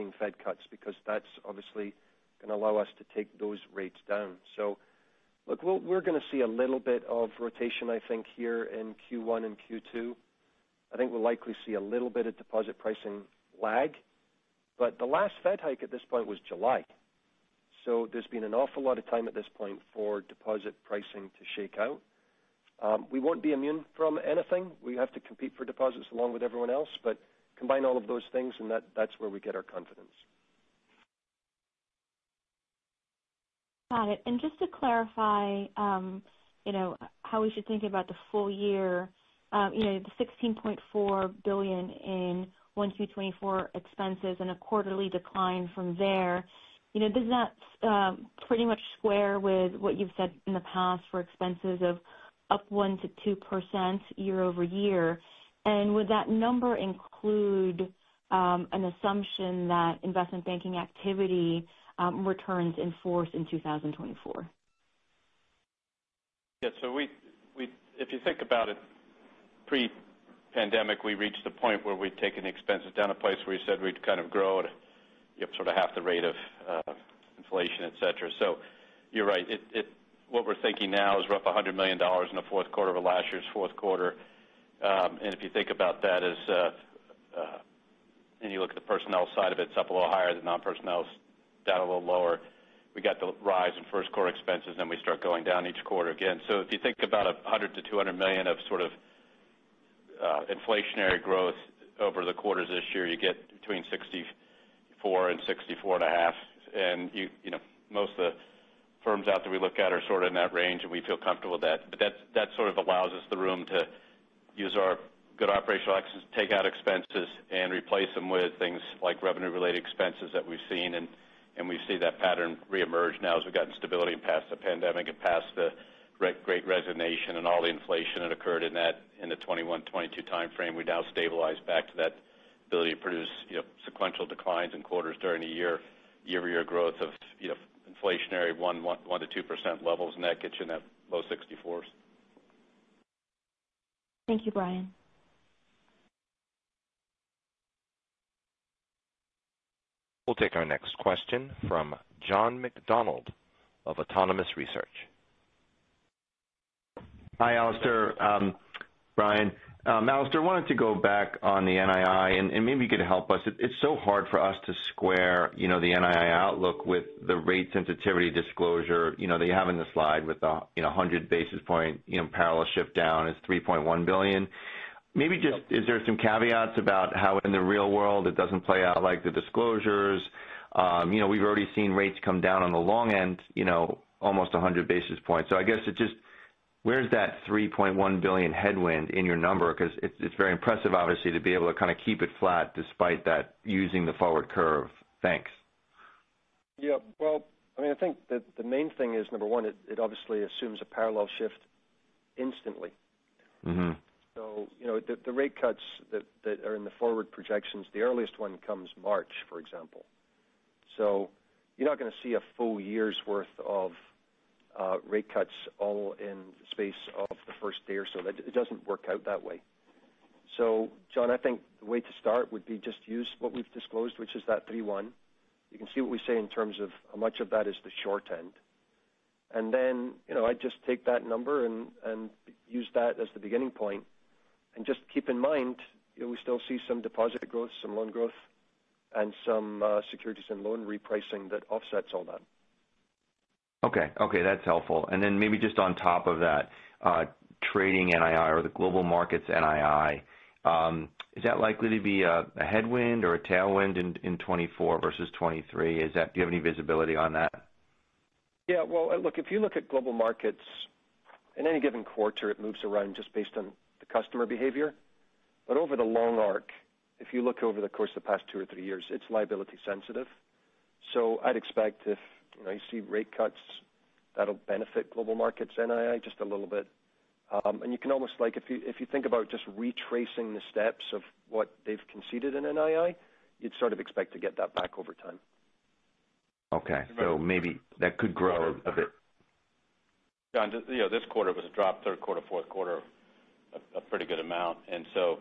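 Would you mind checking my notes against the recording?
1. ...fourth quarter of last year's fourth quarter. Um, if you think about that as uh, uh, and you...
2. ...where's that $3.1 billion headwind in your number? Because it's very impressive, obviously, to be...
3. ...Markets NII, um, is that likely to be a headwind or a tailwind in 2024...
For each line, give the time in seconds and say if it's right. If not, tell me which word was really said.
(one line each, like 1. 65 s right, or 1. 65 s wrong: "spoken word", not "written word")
1. 82 s right
2. 186 s right
3. 249 s right.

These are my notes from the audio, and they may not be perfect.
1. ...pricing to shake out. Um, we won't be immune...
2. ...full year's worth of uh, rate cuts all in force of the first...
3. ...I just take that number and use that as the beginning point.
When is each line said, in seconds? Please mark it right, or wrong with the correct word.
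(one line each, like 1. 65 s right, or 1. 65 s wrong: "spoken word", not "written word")
1. 20 s right
2. 212 s wrong: "space", not "force"
3. 230 s right.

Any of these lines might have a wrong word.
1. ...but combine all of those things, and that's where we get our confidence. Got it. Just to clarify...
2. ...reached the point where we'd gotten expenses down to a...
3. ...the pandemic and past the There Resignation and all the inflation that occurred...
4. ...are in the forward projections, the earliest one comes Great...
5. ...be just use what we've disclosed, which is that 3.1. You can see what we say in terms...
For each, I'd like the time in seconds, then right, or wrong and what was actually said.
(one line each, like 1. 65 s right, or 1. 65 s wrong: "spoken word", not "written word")
1. 27 s right
2. 71 s wrong: "taken", not "gotten"
3. 124 s wrong: "Great", not "There"
4. 206 s wrong: "March", not "Great"
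5. 222 s right.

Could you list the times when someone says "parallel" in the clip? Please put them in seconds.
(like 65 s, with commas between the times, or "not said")
172 s, 200 s.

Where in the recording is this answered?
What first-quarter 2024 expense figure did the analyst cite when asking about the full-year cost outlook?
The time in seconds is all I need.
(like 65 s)
40 s.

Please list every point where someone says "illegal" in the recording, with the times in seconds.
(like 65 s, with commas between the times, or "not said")
not said.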